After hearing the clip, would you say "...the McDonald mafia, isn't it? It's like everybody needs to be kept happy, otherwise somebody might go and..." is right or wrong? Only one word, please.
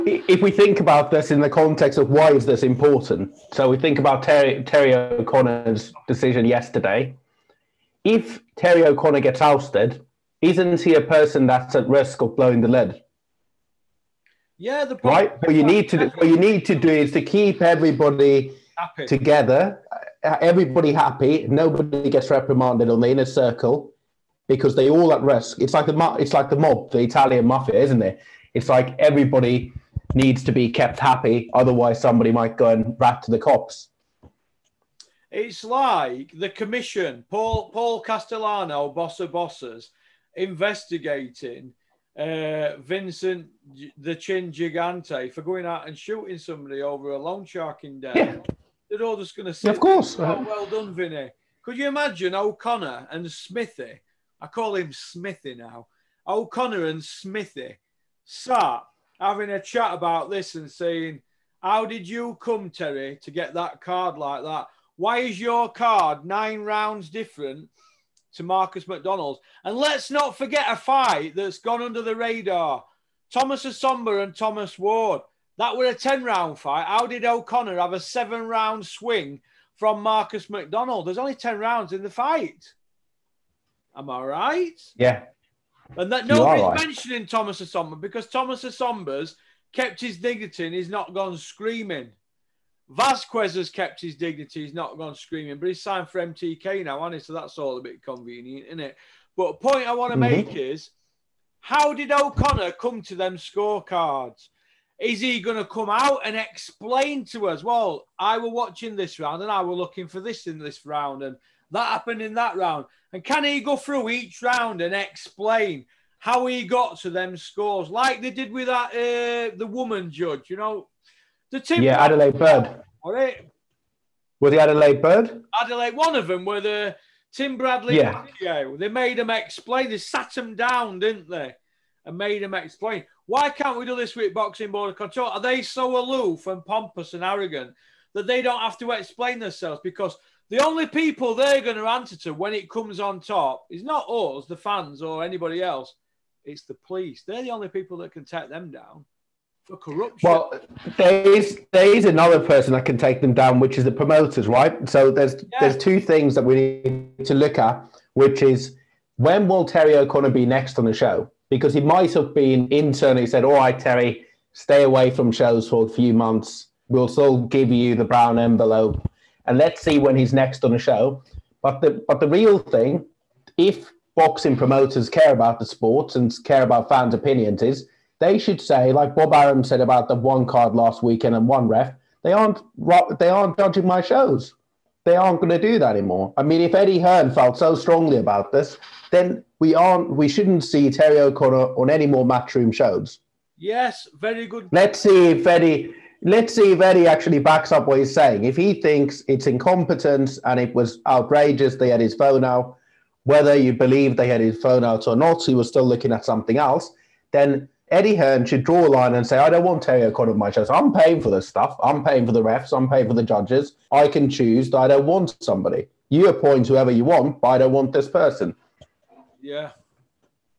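wrong.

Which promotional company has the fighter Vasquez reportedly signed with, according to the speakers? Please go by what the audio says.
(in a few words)
MTK.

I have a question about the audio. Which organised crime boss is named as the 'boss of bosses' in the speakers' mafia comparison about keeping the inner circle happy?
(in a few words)
Paul Castellano.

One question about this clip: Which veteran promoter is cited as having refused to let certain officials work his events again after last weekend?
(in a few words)
Bob Arum.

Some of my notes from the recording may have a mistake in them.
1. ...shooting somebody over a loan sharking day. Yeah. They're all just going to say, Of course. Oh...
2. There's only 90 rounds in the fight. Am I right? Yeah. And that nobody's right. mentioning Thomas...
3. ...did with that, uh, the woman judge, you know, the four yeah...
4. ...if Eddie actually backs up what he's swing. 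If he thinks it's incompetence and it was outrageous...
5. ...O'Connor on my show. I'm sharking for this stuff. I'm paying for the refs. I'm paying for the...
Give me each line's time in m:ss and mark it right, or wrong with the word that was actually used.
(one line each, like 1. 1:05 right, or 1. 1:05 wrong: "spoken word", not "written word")
1. 0:45 right
2. 1:21 wrong: "10", not "90"
3. 1:58 wrong: "two", not "four"
4. 3:16 wrong: "saying", not "swing"
5. 3:30 wrong: "paying", not "sharking".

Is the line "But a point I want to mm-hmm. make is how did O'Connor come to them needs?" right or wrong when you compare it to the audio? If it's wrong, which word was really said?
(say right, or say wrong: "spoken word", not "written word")
wrong: "scorecards", not "needs".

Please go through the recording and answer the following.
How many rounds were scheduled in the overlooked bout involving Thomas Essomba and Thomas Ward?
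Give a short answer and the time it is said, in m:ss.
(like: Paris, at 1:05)
10, at 1:15.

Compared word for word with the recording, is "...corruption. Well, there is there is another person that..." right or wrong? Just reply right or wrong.
right.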